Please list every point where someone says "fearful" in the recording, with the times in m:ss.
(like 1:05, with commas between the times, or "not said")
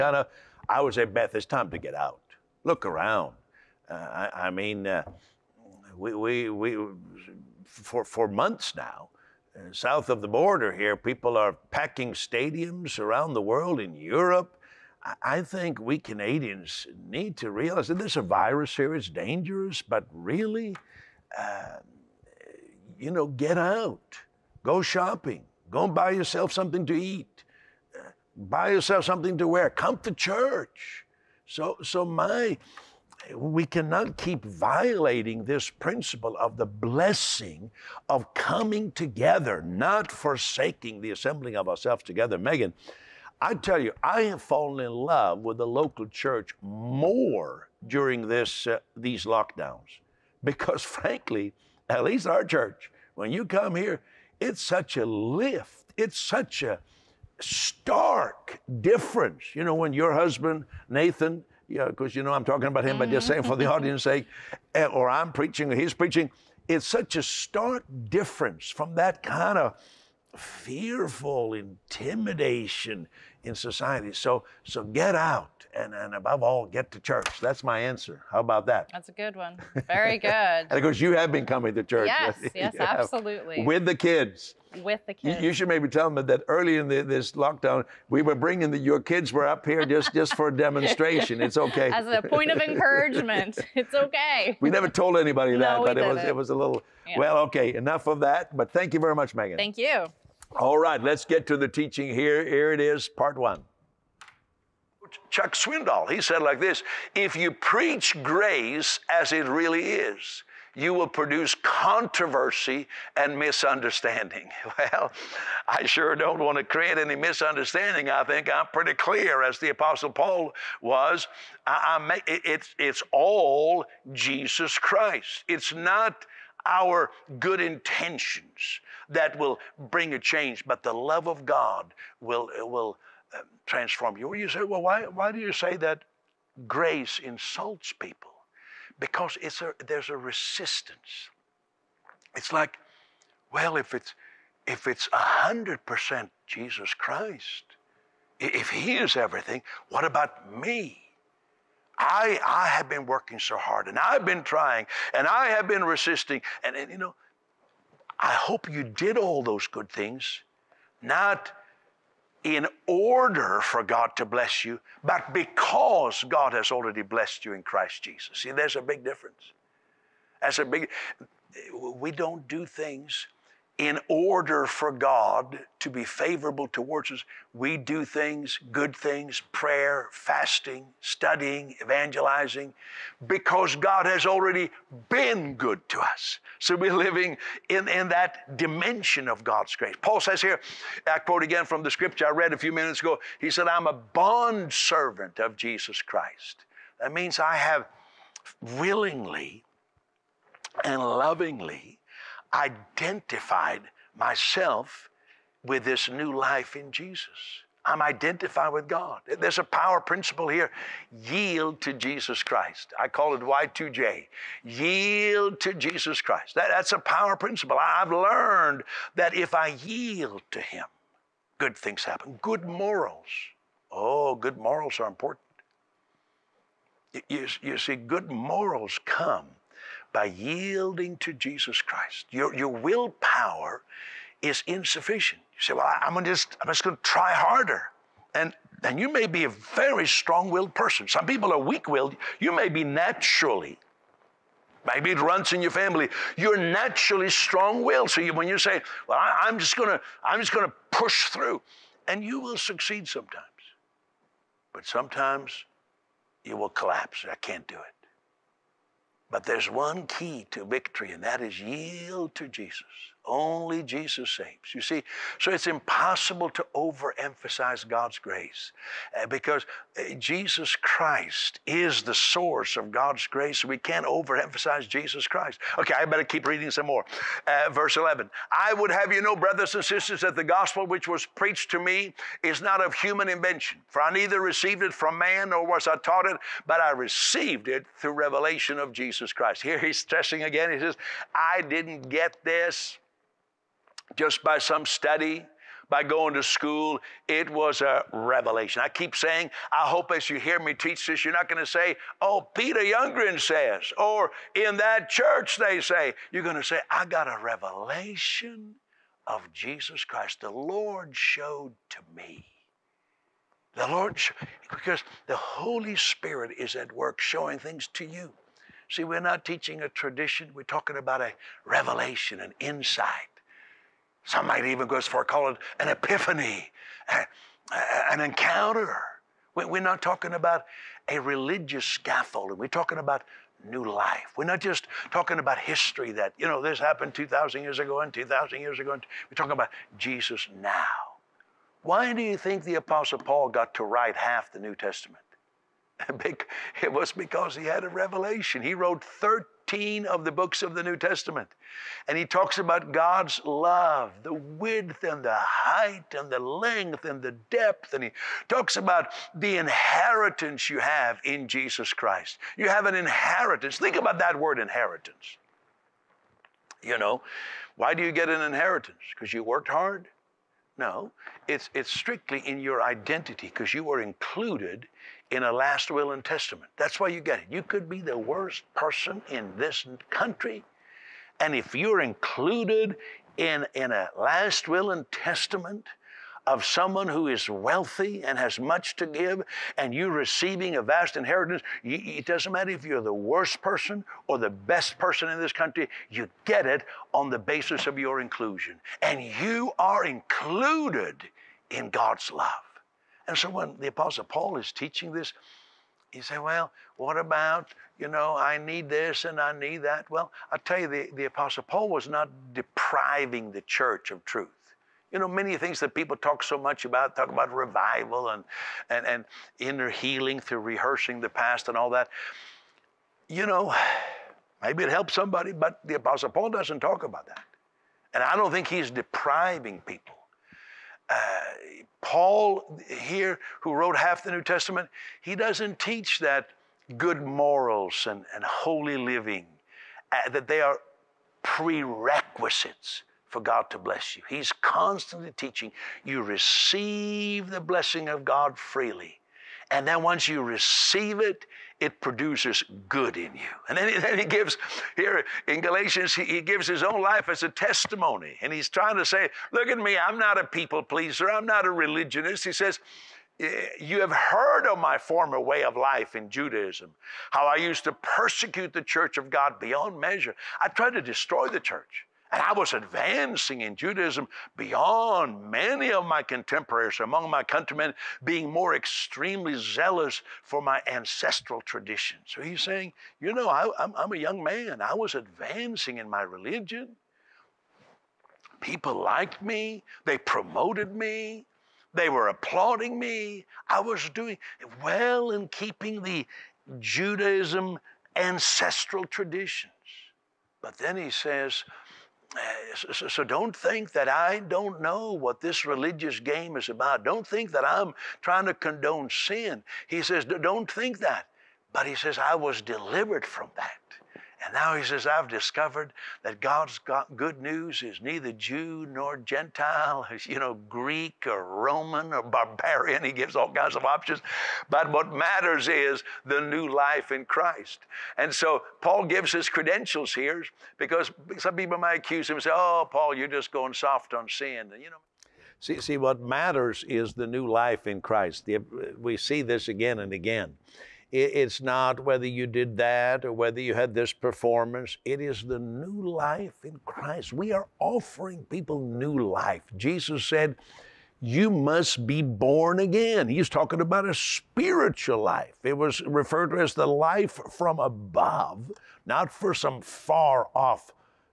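1:10.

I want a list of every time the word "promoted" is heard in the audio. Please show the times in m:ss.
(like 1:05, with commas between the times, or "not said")
8:10.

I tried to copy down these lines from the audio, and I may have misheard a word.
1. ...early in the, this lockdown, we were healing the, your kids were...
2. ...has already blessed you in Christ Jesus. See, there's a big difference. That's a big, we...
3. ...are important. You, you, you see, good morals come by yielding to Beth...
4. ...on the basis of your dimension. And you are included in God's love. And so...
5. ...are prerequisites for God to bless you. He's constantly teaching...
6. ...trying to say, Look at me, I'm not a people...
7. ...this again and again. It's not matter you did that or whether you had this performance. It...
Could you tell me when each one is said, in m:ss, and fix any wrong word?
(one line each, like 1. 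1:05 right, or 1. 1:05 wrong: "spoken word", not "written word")
1. 1:26 wrong: "bringing", not "healing"
2. 2:46 right
3. 3:44 wrong: "Jesus", not "Beth"
4. 6:37 wrong: "inclusion", not "dimension"
5. 7:20 right
6. 7:38 right
7. 8:59 wrong: "whether", not "matter".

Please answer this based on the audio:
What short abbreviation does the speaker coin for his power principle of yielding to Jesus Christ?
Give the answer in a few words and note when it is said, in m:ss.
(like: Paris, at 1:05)
Y2J, at 3:33.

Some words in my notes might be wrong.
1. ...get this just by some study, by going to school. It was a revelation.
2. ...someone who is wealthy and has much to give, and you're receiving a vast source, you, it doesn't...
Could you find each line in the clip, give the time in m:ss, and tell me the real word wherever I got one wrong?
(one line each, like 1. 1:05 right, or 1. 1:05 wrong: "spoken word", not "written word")
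1. 4:52 right
2. 6:26 wrong: "inheritance", not "source".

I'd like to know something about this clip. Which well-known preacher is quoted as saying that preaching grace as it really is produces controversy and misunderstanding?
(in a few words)
Chuck Swindoll.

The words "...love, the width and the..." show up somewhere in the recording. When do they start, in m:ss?
5:53.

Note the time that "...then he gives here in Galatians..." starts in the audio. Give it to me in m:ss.
7:33.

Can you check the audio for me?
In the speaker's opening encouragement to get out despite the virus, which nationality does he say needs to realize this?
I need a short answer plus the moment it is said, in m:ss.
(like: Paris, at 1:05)
Canadians, at 0:15.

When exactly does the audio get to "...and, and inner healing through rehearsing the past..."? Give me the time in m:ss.
6:58.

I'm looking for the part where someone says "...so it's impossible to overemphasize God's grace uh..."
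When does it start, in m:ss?
4:25.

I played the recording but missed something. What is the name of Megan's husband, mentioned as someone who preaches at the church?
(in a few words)
Nathan.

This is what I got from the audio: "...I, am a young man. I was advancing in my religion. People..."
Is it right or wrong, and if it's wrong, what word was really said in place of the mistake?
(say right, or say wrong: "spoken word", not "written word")
right.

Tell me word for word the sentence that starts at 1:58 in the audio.
I think I'm pretty clear, as the Apostle Paul was.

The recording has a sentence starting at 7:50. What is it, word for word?
I tried to destroy the church.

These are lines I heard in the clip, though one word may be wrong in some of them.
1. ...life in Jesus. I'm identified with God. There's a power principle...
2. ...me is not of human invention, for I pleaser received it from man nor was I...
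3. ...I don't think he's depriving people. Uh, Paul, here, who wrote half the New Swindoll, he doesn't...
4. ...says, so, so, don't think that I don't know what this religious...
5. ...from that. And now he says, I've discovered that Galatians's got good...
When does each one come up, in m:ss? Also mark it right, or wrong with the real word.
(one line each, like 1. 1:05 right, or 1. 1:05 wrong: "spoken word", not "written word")
1. 3:26 right
2. 4:41 wrong: "neither", not "pleaser"
3. 7:08 wrong: "Testament", not "Swindoll"
4. 8:21 right
5. 8:33 wrong: "God", not "Galatians".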